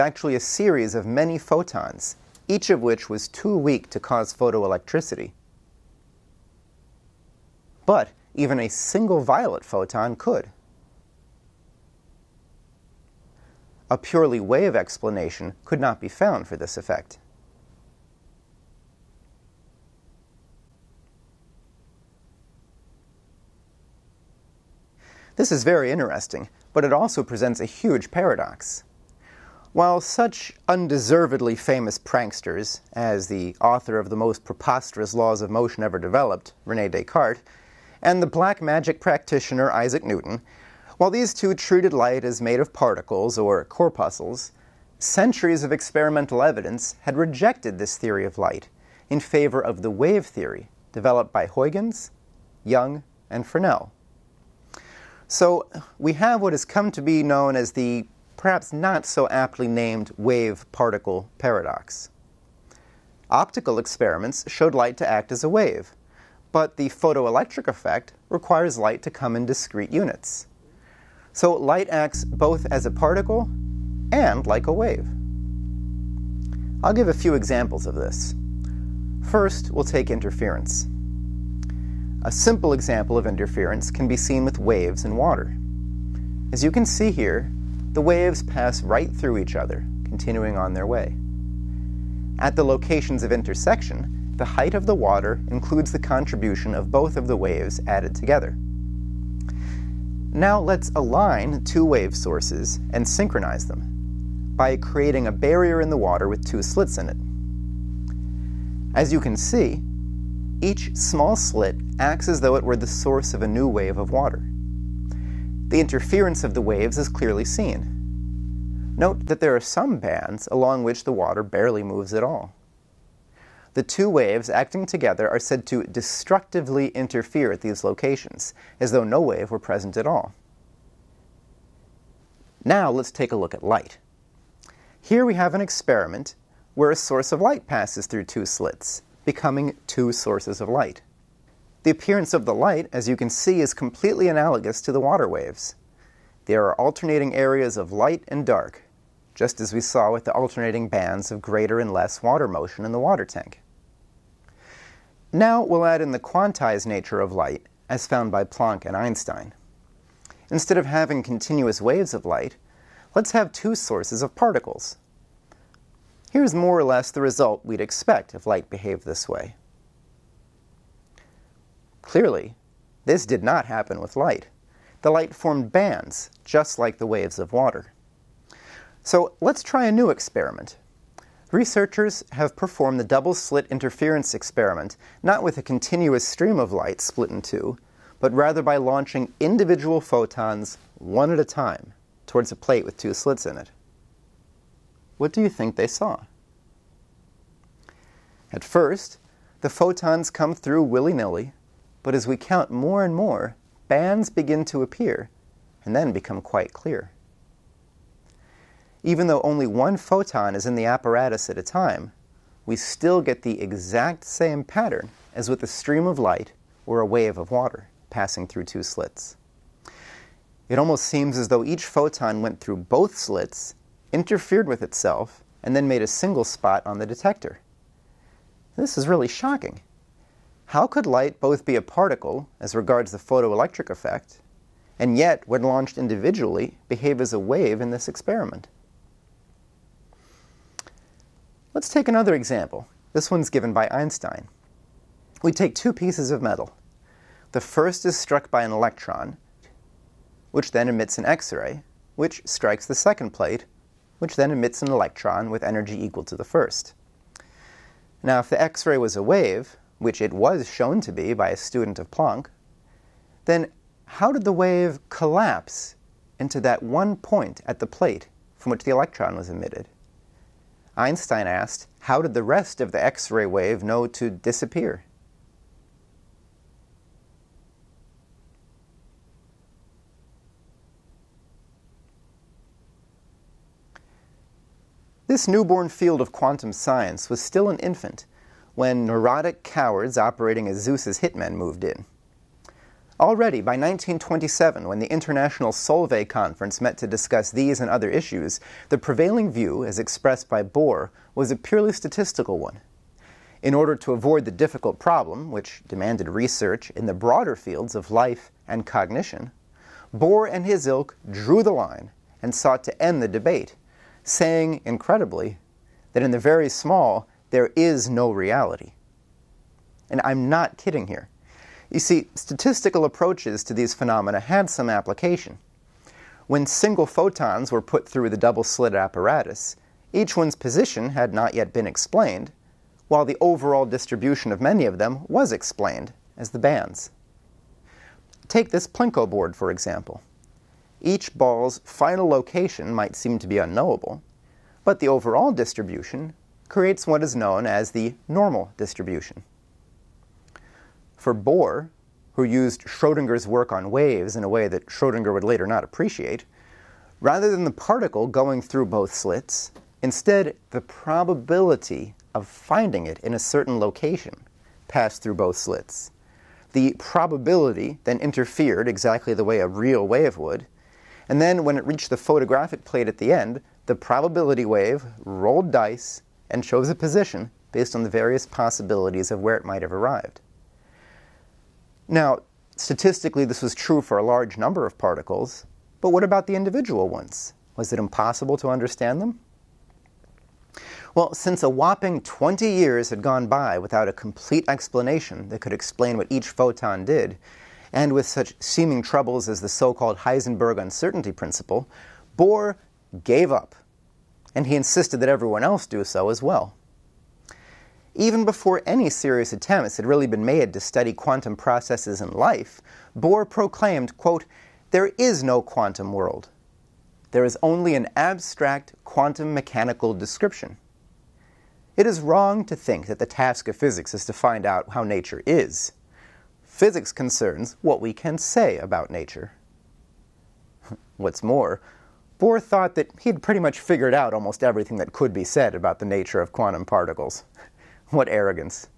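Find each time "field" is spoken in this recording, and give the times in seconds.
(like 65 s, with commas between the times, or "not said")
285 s, 307 s.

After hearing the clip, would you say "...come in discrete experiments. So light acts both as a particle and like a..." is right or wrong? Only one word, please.
wrong.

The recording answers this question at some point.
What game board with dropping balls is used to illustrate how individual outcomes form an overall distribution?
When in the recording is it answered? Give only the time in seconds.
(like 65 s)
338 s.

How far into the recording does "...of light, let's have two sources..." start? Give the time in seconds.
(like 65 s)
162 s.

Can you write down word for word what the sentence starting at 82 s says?
A simple example of interference can be seen with waves in water.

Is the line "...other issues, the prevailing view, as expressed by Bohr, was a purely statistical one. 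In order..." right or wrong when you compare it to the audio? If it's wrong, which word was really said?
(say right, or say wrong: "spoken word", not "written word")
right.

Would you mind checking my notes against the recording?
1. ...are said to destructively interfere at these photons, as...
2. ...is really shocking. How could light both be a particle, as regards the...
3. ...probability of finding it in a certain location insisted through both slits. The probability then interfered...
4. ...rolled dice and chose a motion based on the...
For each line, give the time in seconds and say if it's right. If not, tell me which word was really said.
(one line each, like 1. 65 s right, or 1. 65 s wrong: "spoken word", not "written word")
1. 125 s wrong: "locations", not "photons"
2. 228 s right
3. 360 s wrong: "passed", not "insisted"
4. 375 s wrong: "position", not "motion".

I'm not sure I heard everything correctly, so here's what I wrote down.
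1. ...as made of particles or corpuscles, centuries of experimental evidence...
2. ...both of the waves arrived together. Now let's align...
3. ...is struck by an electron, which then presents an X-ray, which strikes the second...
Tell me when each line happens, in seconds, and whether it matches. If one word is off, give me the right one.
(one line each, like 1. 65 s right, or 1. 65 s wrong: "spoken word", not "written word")
1. 42 s right
2. 96 s wrong: "added", not "arrived"
3. 248 s wrong: "emits", not "presents".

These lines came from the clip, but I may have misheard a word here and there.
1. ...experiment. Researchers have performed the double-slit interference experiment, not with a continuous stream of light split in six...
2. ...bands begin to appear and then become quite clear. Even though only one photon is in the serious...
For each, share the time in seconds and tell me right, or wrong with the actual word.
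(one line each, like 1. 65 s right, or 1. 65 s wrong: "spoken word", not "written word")
1. 180 s wrong: "two", not "six"
2. 203 s wrong: "apparatus", not "serious".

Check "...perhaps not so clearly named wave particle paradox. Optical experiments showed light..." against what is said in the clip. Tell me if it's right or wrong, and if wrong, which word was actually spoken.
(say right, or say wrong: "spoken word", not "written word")
wrong: "aptly", not "clearly".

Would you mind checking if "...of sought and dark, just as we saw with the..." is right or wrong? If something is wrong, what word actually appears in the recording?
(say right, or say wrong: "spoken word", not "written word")
wrong: "light", not "sought".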